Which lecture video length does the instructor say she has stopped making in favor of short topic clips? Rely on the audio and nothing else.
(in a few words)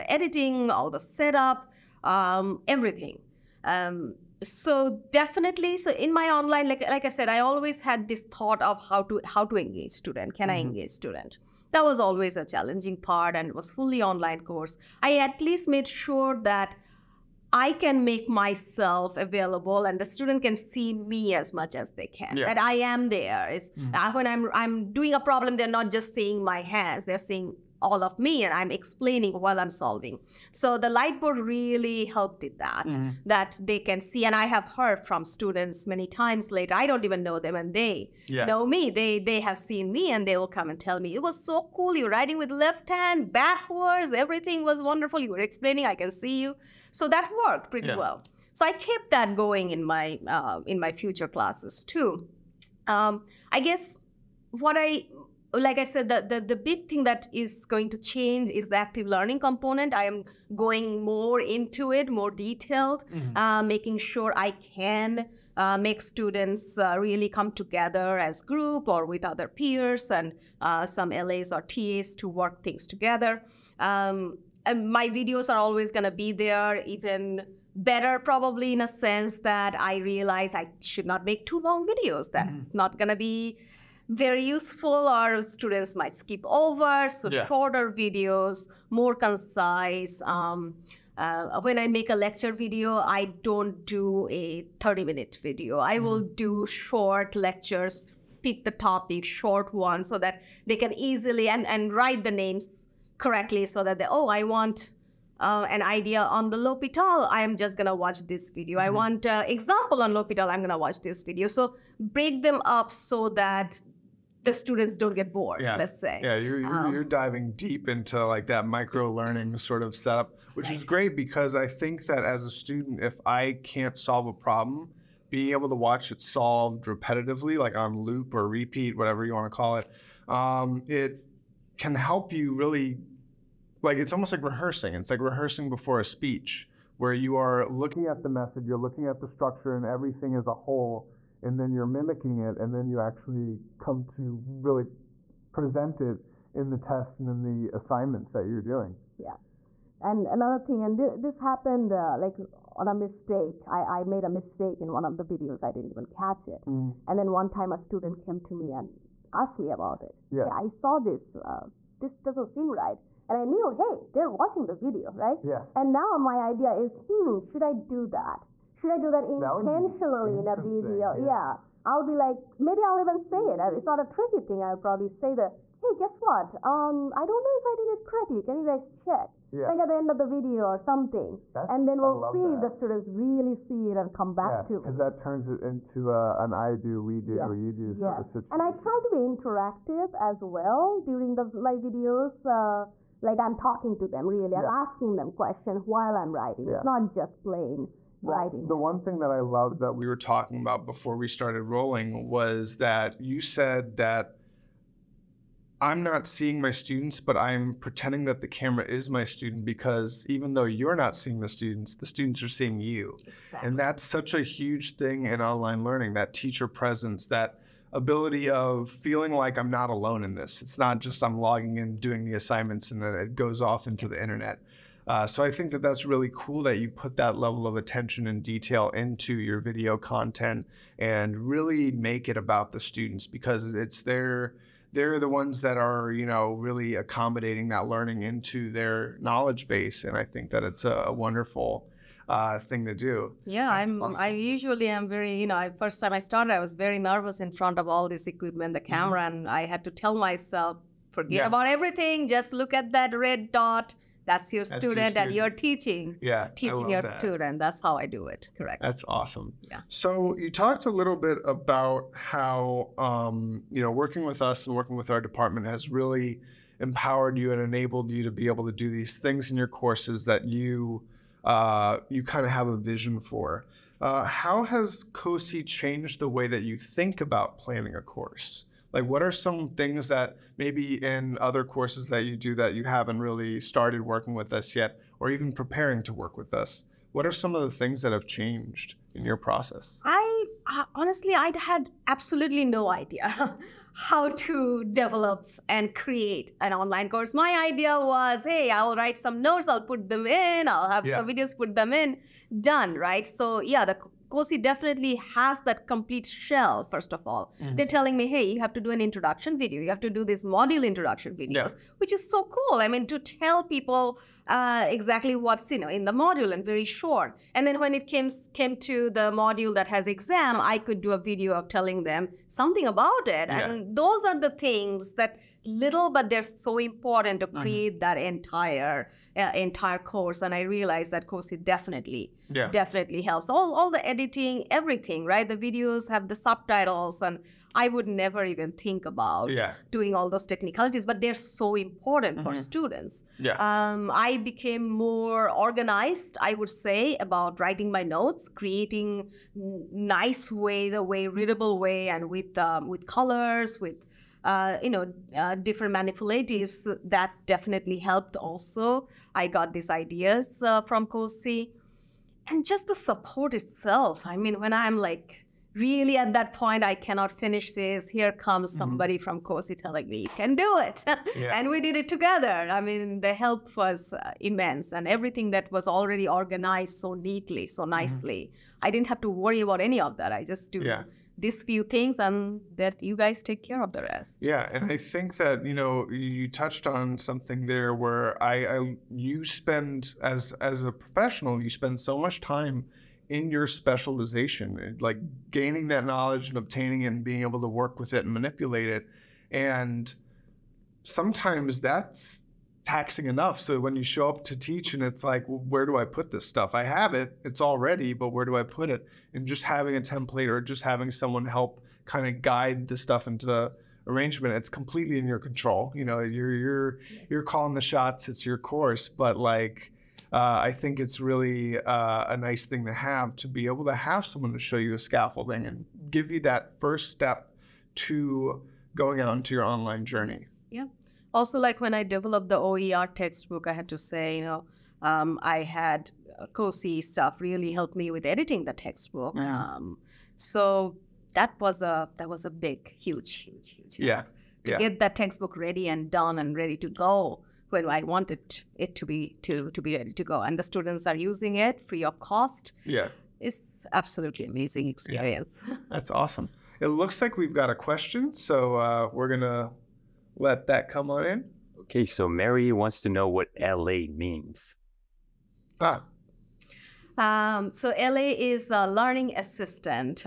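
30 minute.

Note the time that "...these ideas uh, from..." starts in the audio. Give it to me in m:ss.
5:59.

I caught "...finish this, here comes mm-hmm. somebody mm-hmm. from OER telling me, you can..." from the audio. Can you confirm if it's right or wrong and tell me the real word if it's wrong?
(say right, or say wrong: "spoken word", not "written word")
wrong: "COSI", not "OER".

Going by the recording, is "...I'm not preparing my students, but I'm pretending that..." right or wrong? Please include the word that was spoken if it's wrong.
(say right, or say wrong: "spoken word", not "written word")
wrong: "seeing", not "preparing".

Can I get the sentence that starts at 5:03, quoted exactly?
So yeah, the COSI definitely has that complete shell, first of all.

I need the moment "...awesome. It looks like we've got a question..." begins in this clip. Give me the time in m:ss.
7:36.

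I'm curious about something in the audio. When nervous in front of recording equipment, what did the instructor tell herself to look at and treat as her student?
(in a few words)
red dot.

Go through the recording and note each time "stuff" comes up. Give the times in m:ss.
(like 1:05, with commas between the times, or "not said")
6:46, 6:52, 7:17.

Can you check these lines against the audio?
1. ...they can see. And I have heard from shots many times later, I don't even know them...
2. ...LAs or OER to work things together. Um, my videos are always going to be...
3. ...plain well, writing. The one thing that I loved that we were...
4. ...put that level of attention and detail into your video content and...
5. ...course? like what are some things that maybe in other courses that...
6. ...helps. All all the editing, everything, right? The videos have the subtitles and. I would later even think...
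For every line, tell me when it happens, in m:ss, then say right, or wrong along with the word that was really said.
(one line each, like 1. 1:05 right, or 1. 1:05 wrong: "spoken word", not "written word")
1. 0:33 wrong: "students", not "shots"
2. 1:11 wrong: "TAs", not "OER"
3. 3:17 right
4. 3:46 right
5. 4:38 right
6. 5:33 wrong: "never", not "later".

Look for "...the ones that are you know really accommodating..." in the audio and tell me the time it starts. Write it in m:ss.
3:55.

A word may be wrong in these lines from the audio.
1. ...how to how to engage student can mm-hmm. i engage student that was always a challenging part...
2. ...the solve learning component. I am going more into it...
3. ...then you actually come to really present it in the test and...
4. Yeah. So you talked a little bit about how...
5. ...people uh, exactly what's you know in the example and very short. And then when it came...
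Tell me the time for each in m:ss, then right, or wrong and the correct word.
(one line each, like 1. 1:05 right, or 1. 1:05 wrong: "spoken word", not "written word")
1. 0:08 right
2. 0:58 wrong: "active", not "solve"
3. 2:22 right
4. 4:19 right
5. 5:13 wrong: "module", not "example".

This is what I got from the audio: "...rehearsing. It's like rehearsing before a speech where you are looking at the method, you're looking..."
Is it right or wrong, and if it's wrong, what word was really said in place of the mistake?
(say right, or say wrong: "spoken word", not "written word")
right.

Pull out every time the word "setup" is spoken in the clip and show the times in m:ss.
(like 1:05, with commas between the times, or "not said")
0:00, 1:59.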